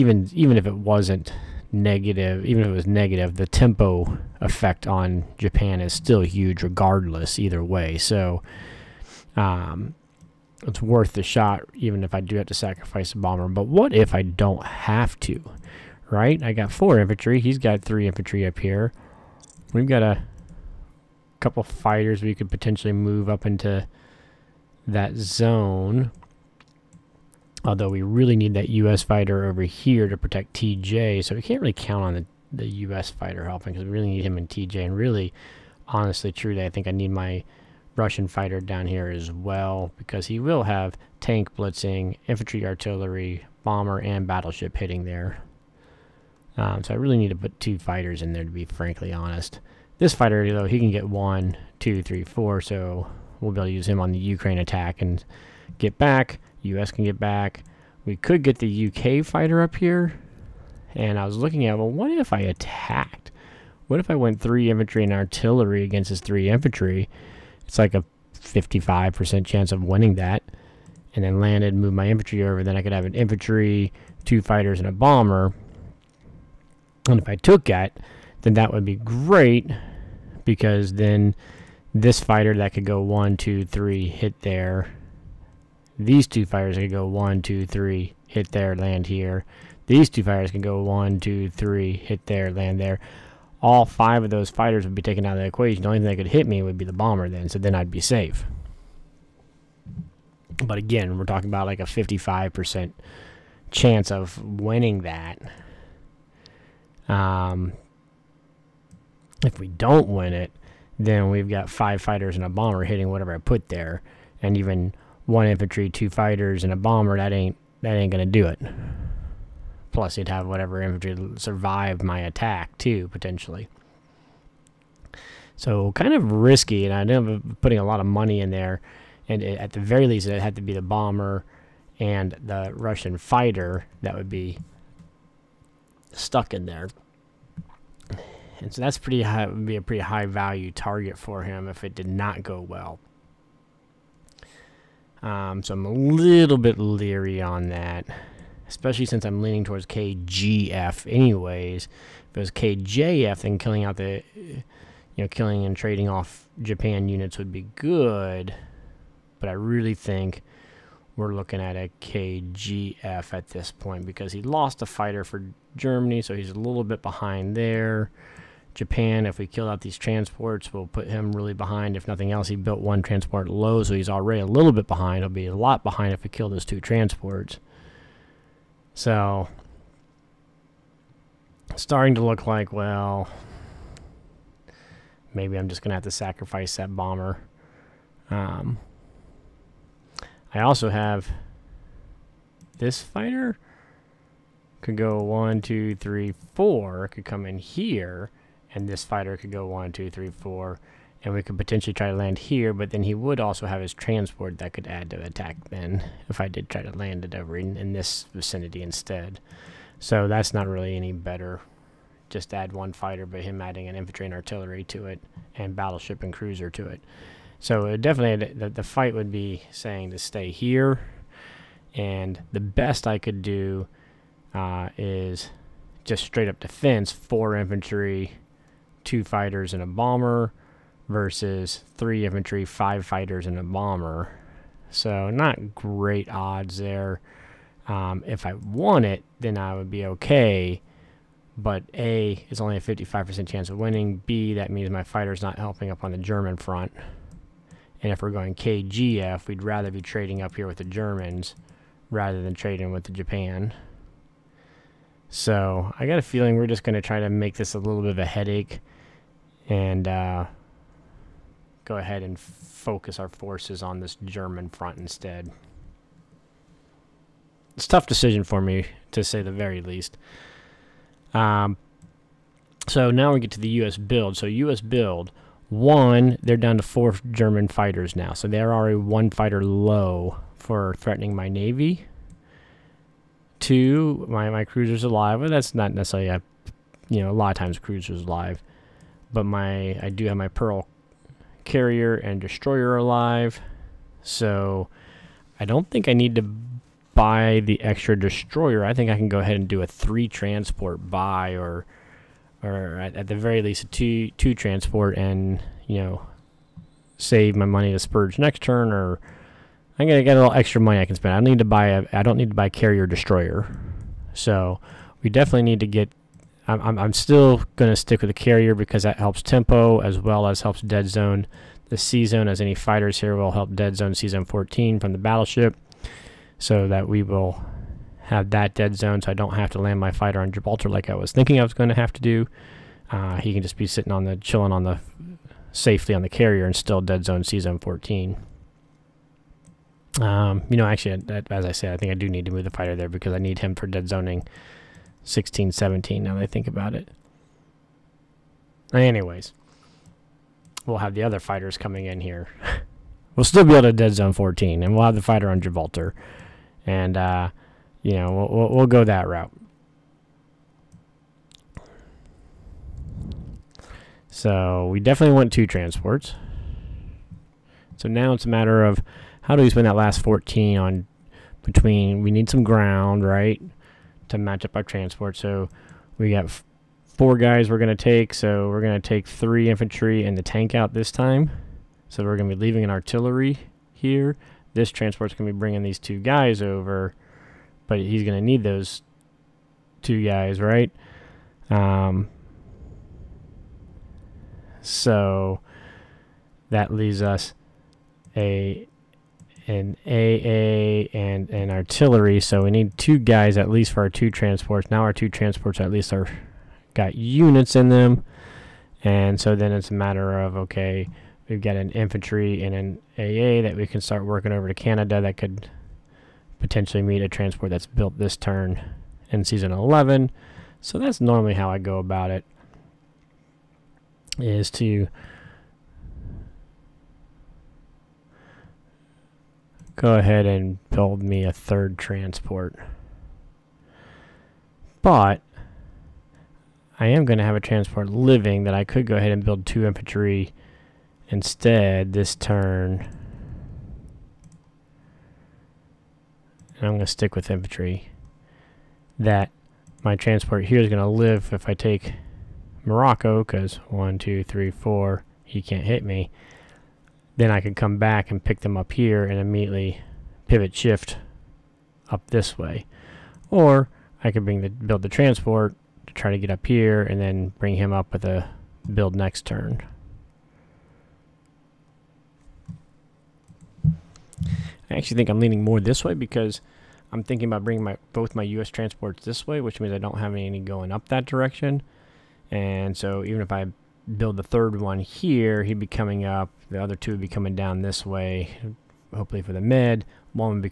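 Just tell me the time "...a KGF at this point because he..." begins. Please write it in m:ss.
2:41.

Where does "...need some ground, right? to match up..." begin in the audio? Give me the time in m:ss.
6:12.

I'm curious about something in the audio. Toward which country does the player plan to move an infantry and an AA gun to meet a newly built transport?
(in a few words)
Canada.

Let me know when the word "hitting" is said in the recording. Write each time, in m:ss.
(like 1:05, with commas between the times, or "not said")
0:44, 1:52.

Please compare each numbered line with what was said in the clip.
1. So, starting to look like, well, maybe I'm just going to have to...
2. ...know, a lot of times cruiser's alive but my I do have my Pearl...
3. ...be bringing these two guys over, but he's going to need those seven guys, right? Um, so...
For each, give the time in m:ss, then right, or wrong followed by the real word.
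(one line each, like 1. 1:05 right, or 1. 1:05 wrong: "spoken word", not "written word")
1. 2:58 right
2. 4:47 right
3. 6:25 wrong: "two", not "seven".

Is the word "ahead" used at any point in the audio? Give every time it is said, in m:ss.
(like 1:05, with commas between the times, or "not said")
4:21, 4:59, 7:10, 7:19.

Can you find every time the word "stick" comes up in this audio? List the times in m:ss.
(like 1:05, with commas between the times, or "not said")
5:17, 7:27.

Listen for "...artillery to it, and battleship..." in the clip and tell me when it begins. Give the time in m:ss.
3:34.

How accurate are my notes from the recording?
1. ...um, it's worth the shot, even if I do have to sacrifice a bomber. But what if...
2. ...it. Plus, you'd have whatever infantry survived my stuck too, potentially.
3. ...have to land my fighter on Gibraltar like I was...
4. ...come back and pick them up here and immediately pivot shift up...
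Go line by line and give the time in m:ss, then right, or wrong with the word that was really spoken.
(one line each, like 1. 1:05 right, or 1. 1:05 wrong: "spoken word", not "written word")
1. 0:09 right
2. 1:58 wrong: "attack", not "stuck"
3. 5:29 right
4. 7:37 right.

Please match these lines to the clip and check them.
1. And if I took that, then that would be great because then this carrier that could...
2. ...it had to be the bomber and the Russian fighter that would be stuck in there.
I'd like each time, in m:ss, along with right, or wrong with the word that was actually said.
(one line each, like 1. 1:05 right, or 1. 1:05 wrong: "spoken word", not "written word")
1. 1:17 wrong: "fighter", not "carrier"
2. 2:10 right.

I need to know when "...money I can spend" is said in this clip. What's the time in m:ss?
5:10.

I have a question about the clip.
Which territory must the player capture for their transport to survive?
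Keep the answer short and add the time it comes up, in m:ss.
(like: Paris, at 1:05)
Morocco, at 7:32.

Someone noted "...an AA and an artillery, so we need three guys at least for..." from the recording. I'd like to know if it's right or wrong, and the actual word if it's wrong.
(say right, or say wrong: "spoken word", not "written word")
wrong: "two", not "three".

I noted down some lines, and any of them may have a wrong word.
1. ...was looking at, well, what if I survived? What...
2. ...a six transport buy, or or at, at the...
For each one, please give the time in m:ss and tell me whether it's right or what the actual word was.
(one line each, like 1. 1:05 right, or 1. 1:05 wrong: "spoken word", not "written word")
1. 1:01 wrong: "attacked", not "survived"
2. 4:59 wrong: "three", not "six".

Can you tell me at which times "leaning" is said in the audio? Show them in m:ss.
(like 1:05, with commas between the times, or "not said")
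2:29, 7:55.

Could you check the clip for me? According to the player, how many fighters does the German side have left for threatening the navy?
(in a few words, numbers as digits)
4.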